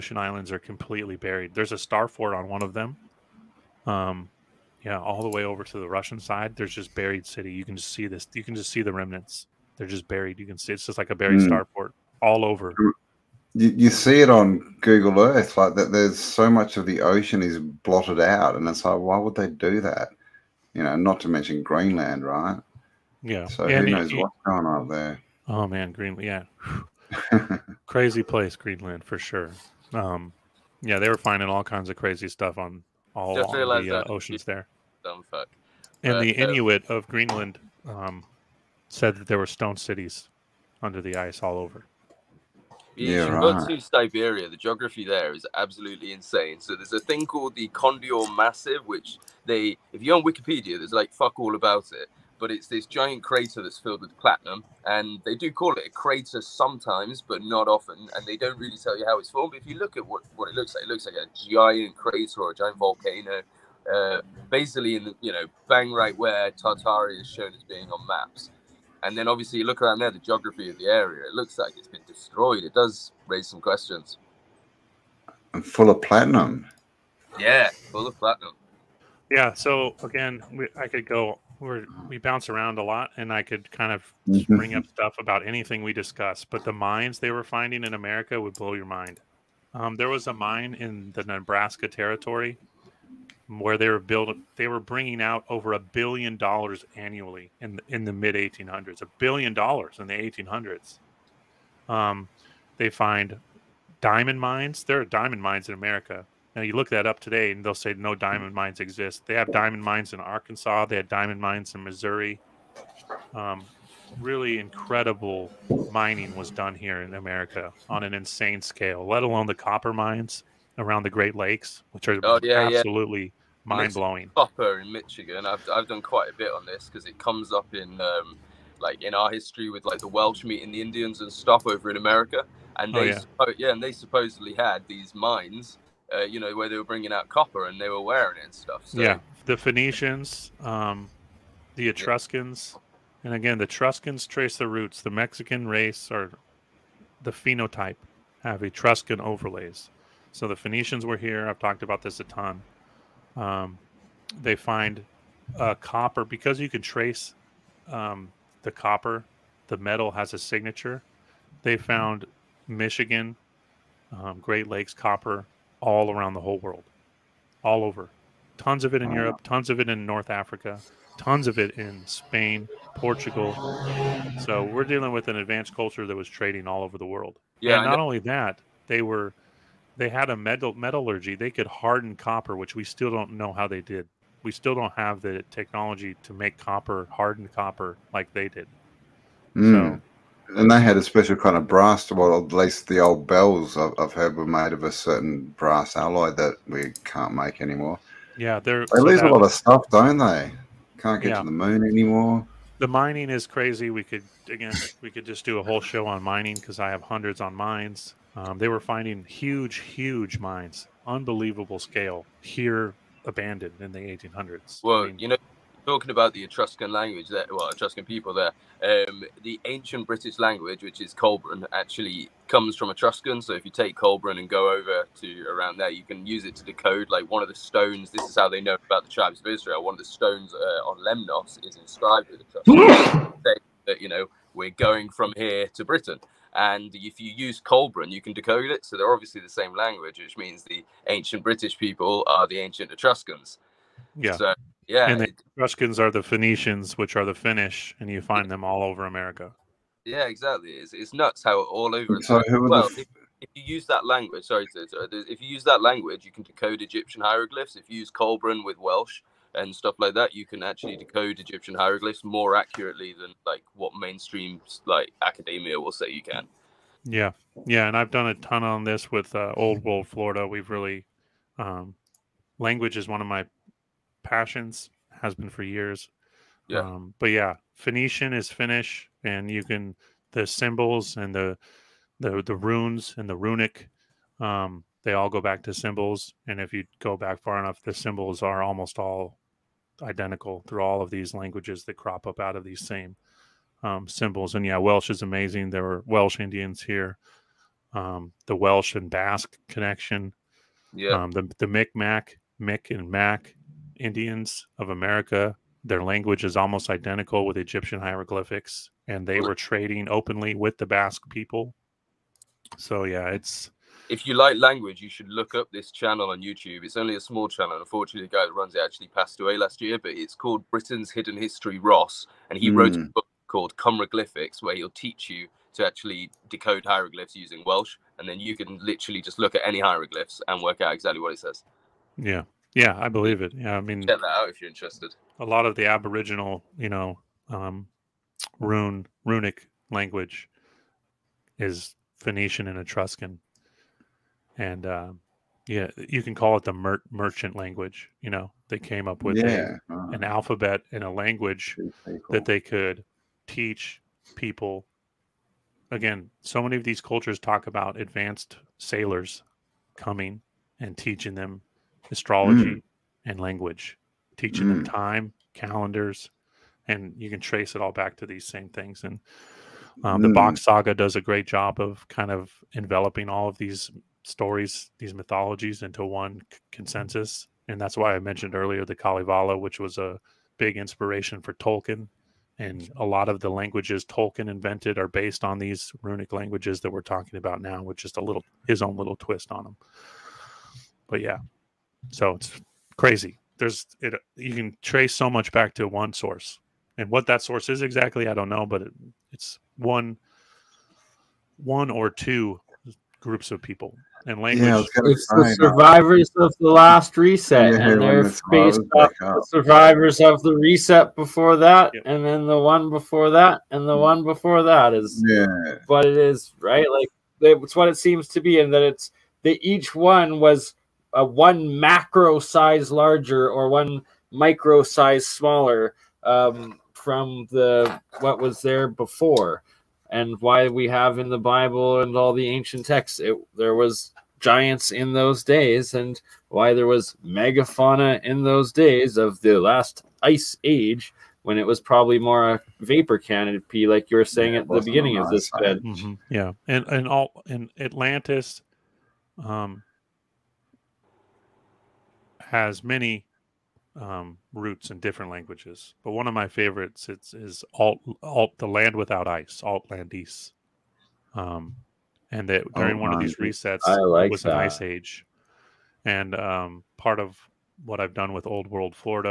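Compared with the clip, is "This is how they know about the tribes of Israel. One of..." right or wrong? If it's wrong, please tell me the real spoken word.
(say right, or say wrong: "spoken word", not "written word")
right.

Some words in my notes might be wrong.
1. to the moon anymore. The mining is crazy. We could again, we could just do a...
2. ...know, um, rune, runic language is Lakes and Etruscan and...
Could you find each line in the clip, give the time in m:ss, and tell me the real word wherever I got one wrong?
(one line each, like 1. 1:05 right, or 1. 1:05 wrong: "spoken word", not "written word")
1. 3:21 right
2. 5:36 wrong: "Phoenician", not "Lakes".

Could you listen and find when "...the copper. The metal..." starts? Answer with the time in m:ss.
2:38.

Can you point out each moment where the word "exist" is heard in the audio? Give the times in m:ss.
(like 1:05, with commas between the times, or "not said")
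1:48.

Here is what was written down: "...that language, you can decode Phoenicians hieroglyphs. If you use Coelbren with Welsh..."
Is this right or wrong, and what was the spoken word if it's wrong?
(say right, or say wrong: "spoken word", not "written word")
wrong: "Egyptian", not "Phoenicians".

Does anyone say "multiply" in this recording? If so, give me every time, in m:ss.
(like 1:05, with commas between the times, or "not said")
not said.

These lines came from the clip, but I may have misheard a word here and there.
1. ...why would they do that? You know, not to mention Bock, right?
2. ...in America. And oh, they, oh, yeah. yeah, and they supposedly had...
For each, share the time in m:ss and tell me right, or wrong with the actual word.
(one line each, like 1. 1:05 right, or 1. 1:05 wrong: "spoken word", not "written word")
1. 0:18 wrong: "Greenland", not "Bock"
2. 2:11 right.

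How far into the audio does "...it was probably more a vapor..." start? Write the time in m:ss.
7:21.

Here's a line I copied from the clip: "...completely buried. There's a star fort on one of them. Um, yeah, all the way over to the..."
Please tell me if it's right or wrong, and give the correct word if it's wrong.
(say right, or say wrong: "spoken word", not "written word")
right.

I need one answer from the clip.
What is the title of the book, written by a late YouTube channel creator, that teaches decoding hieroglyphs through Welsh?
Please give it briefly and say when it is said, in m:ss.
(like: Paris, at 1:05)
Cymryglyphics, at 5:23.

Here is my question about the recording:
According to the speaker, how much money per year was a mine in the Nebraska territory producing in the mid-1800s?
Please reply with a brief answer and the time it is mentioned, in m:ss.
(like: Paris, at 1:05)
over a billion dollars, at 1:35.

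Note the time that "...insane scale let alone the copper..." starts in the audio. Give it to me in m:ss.
1:58.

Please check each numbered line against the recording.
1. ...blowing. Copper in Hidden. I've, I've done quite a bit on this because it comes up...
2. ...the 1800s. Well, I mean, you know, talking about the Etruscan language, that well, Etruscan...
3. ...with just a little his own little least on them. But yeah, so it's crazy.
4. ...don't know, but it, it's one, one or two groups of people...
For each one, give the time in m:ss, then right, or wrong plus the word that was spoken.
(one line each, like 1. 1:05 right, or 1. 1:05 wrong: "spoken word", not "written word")
1. 2:03 wrong: "Michigan", not "Hidden"
2. 3:33 right
3. 6:27 wrong: "twist", not "least"
4. 6:38 right.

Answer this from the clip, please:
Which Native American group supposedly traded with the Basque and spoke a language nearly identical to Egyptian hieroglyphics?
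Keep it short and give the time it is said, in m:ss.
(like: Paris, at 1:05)
Micmac, at 5:01.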